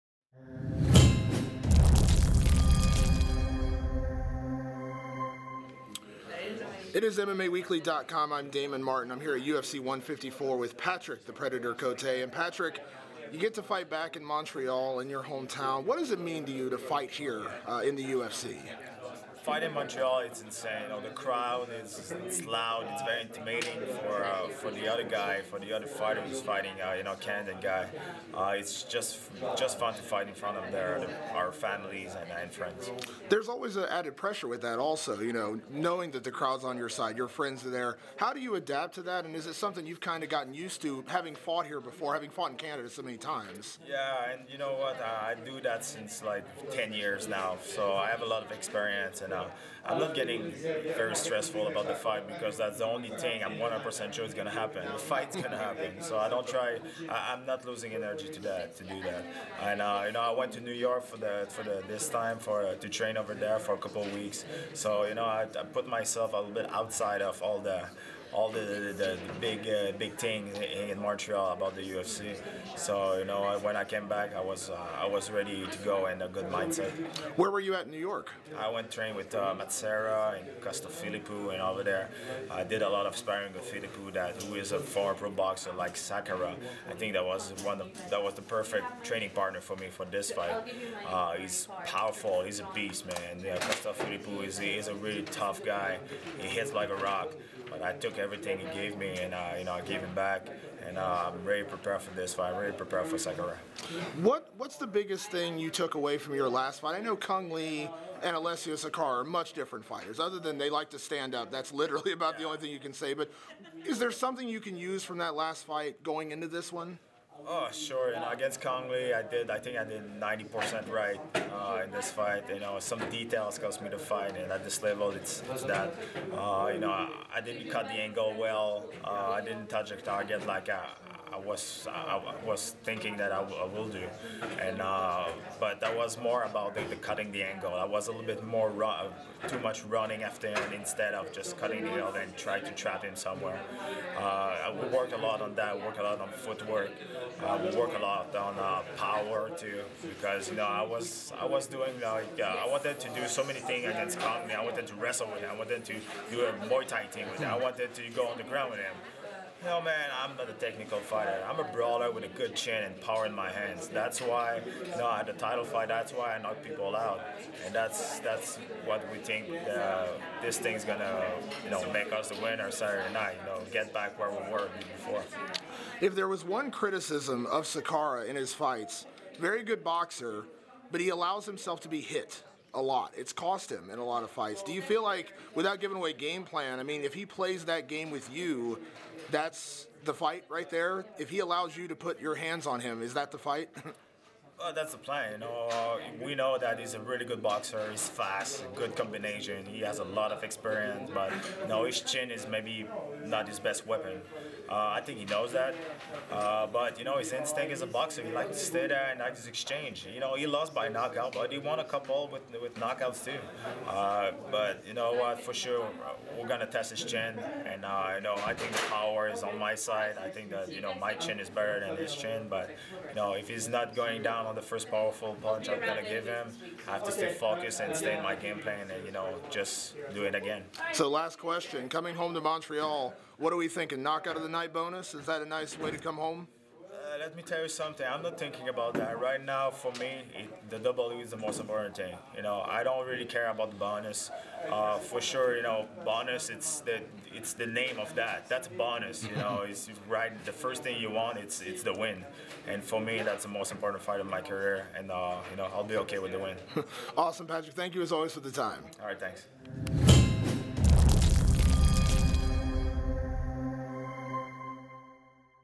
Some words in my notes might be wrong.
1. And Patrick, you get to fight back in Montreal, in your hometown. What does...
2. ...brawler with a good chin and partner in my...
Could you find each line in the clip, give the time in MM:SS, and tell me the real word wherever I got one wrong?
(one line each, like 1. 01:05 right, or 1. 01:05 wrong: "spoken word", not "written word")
1. 00:12 right
2. 02:41 wrong: "power", not "partner".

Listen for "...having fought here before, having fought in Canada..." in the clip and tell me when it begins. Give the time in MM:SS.
00:41.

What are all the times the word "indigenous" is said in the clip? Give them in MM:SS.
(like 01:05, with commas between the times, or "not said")
not said.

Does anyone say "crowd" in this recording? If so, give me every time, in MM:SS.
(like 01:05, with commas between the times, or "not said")
00:21, 00:36.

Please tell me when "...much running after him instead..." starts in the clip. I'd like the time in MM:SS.
02:19.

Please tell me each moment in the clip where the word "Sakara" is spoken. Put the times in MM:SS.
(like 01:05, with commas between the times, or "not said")
01:25, 01:48, 02:57.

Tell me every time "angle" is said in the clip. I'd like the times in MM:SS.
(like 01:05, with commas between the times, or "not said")
02:07, 02:17, 02:21.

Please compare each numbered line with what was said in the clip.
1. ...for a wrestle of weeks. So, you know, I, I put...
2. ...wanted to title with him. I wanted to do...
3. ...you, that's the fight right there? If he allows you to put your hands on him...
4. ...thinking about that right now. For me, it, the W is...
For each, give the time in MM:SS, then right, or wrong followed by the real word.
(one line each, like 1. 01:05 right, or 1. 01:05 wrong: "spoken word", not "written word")
1. 01:03 wrong: "couple", not "wrestle"
2. 02:34 wrong: "wrestle", not "title"
3. 03:08 right
4. 03:58 right.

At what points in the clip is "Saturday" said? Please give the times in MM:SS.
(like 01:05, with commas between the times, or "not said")
02:52.